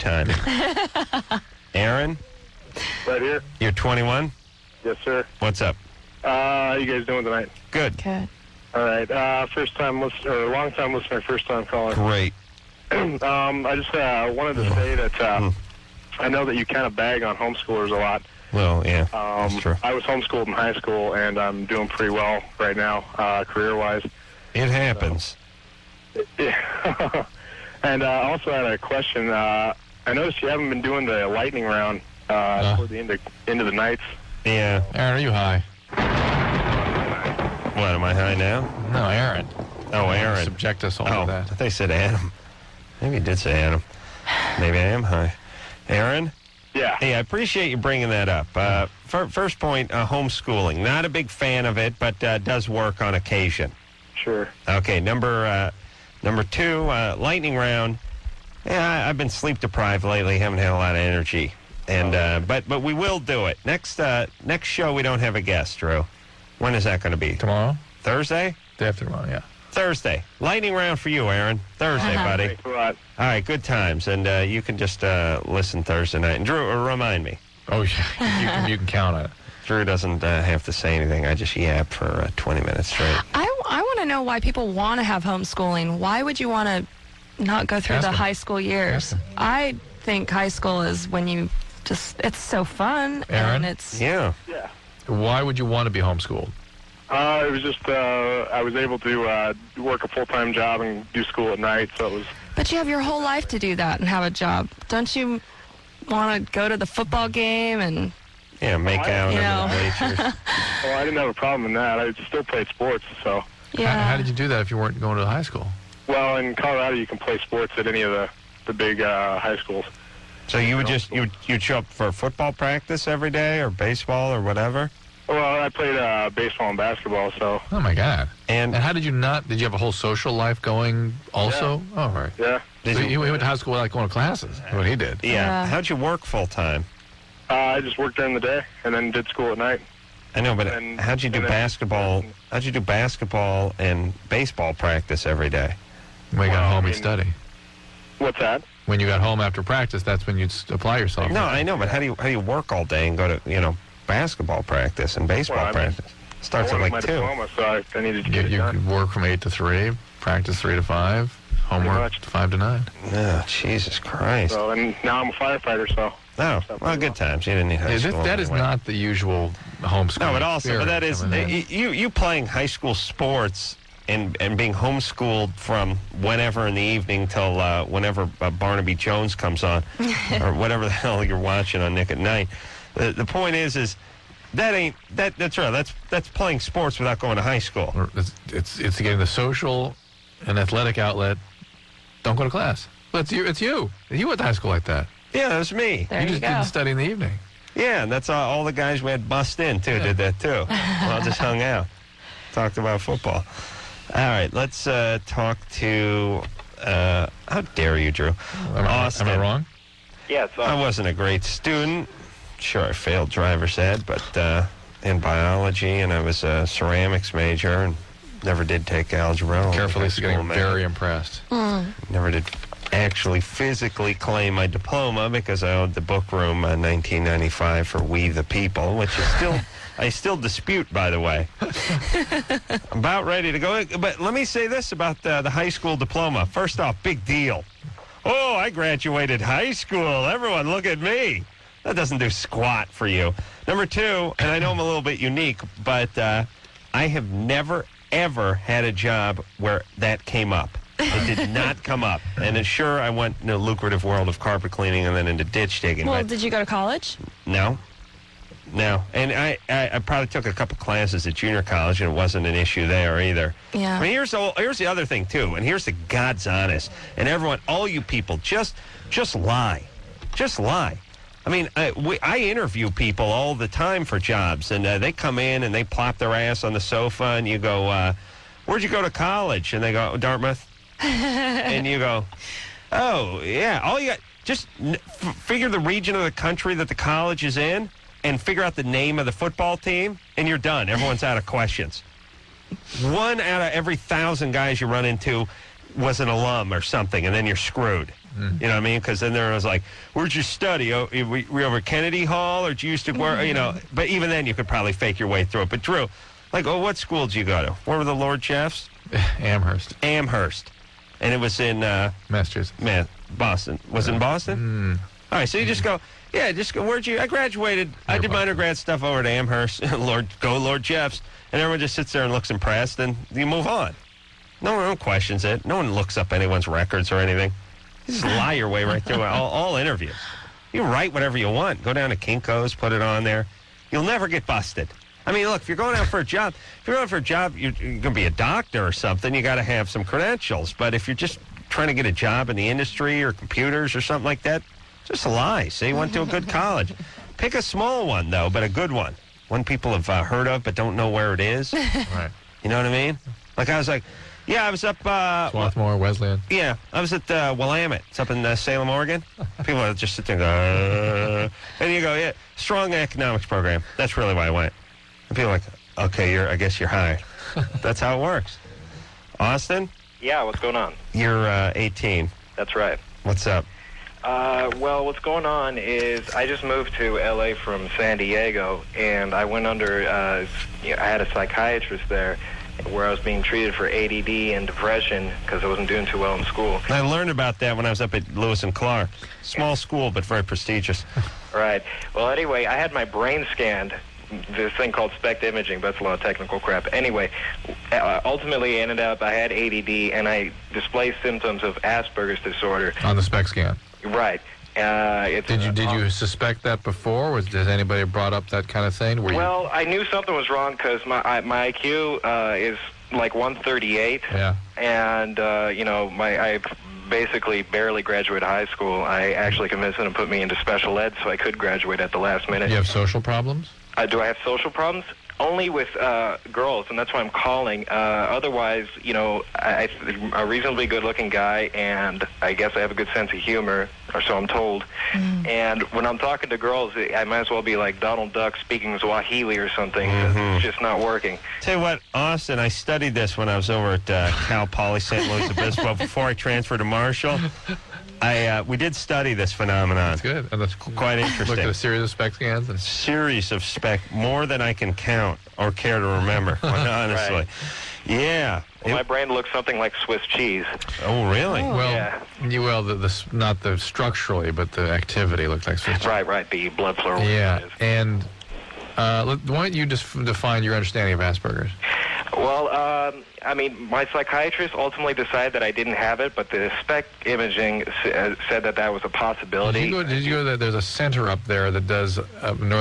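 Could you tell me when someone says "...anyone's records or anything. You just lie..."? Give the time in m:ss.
5:26.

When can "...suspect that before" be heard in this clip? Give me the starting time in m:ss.
6:46.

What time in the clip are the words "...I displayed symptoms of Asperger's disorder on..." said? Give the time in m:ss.
6:40.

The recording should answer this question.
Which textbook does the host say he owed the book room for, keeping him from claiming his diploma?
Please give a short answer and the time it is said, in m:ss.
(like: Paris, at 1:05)
We the People, at 3:48.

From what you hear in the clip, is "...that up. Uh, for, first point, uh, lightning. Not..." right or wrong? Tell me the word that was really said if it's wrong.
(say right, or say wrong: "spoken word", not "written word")
wrong: "homeschooling", not "lightning".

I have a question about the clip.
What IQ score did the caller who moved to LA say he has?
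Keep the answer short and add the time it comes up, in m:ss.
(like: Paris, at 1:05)
138, at 6:53.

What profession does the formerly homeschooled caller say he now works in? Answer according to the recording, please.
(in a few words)
Firefighter.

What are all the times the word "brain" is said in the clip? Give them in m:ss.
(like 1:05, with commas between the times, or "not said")
6:33, 7:39.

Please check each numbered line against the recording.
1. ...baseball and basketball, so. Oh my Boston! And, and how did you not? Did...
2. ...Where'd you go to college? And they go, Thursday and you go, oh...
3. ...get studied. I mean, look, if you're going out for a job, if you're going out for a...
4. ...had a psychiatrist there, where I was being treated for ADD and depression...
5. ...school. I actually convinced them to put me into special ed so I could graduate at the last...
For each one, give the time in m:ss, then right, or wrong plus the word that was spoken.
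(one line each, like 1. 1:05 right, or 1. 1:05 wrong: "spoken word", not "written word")
1. 2:06 wrong: "God", not "Boston"
2. 4:38 wrong: "Dartmouth", not "Thursday"
3. 5:34 wrong: "busted", not "studied"
4. 6:21 right
5. 6:58 right.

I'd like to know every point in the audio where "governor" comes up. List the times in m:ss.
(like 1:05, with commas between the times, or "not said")
not said.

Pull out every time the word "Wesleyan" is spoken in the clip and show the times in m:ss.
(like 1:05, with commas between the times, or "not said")
5:55.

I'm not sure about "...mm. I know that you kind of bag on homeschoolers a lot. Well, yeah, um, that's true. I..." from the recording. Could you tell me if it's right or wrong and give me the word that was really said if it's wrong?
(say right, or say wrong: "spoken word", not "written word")
right.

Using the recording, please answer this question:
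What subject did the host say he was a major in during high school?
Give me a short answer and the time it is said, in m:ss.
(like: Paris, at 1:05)
Ceramics, at 3:36.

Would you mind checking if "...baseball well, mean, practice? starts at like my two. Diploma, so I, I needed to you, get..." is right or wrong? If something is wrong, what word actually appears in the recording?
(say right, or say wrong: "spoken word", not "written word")
right.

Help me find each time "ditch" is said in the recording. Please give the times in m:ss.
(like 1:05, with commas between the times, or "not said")
4:15.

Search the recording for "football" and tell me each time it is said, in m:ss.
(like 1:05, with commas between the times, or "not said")
1:46, 2:02, 3:23, 4:49.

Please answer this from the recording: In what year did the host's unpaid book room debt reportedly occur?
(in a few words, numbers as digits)
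1995.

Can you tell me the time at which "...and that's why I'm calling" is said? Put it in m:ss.
7:06.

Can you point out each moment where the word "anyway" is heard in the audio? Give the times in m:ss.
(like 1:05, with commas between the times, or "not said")
6:32, 6:36.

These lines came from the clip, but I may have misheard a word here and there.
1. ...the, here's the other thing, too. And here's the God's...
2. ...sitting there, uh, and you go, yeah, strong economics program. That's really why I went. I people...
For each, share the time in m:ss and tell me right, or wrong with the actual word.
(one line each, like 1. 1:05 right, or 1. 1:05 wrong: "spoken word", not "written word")
1. 4:24 right
2. 6:00 right.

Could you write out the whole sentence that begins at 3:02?
The, the point is, is that ain't that that's right.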